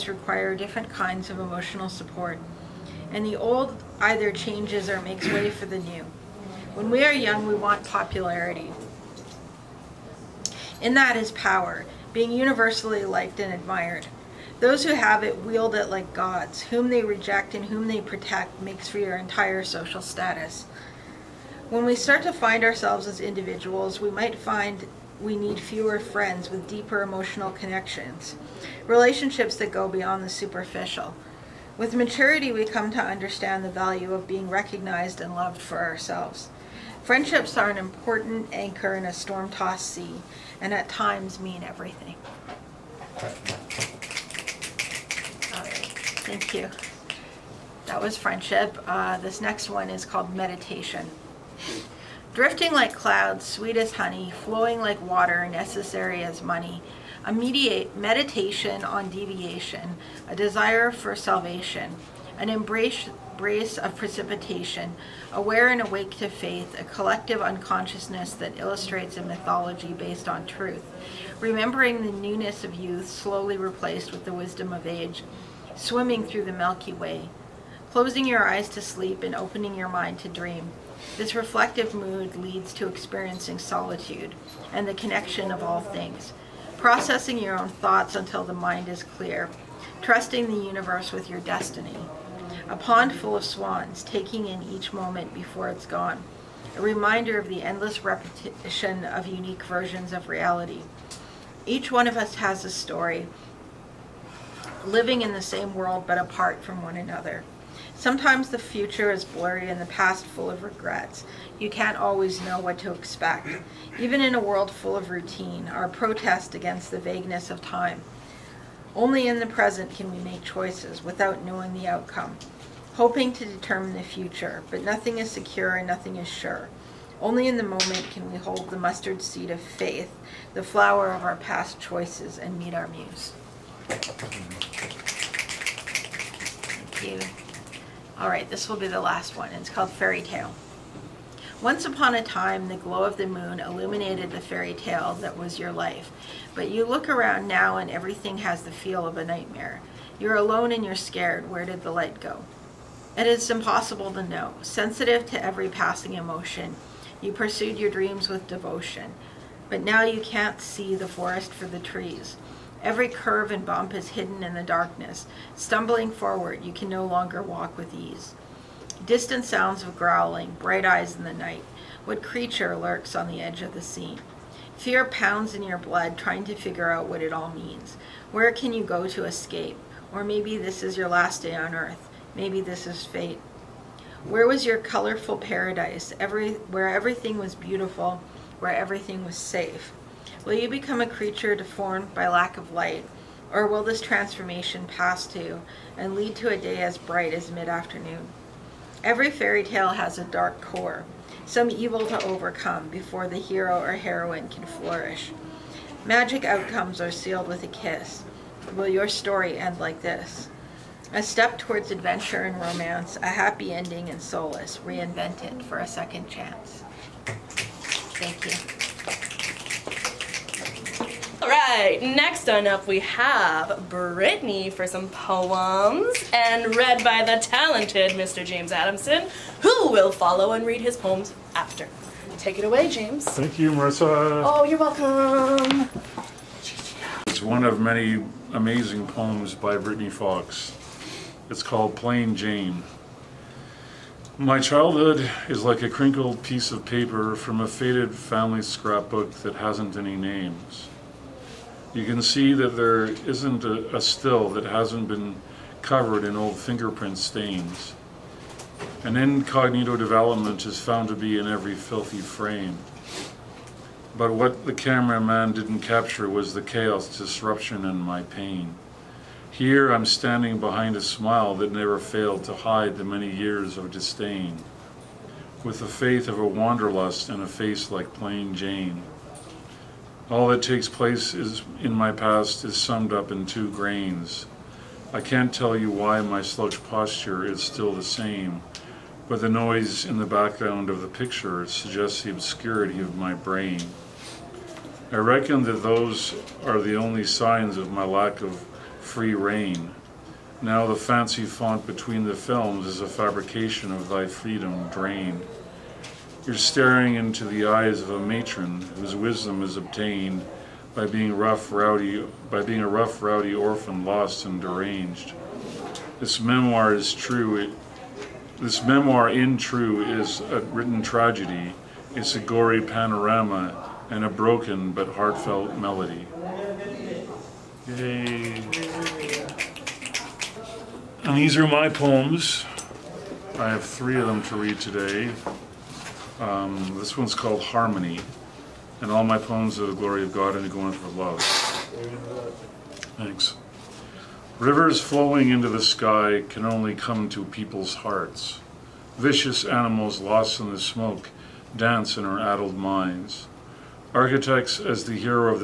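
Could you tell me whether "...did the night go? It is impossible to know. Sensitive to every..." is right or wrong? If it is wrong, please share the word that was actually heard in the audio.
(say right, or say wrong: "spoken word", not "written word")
wrong: "light", not "night".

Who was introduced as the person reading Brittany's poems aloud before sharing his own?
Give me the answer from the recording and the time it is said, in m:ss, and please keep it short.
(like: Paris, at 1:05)
James Adamson, at 3:48.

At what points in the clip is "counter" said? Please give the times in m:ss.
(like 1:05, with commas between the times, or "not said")
not said.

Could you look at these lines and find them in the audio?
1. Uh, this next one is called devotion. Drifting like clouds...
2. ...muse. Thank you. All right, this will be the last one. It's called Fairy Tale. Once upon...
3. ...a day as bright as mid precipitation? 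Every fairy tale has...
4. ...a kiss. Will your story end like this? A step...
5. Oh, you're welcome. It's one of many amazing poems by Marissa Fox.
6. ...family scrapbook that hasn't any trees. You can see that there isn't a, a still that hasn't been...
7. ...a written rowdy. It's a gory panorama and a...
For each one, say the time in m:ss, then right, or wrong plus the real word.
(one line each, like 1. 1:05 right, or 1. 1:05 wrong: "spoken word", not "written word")
1. 0:48 wrong: "meditation", not "devotion"
2. 2:12 right
3. 3:16 wrong: "afternoon", not "precipitation"
4. 3:27 right
5. 3:54 wrong: "Brittany", not "Marissa"
6. 4:08 wrong: "names", not "trees"
7. 5:20 wrong: "tragedy", not "rowdy".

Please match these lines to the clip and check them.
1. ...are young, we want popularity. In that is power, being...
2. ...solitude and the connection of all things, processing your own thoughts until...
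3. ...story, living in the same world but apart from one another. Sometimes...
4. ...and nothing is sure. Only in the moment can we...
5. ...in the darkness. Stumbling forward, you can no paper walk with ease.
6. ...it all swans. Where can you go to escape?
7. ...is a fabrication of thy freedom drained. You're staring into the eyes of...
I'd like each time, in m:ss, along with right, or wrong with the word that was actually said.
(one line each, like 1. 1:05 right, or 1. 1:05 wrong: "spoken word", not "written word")
1. 0:07 right
2. 1:23 right
3. 1:42 right
4. 2:05 right
5. 2:44 wrong: "longer", not "paper"
6. 2:57 wrong: "means", not "swans"
7. 5:02 right.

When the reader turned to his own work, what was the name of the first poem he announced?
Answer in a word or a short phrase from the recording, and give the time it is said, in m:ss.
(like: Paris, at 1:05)
Harmony, at 5:37.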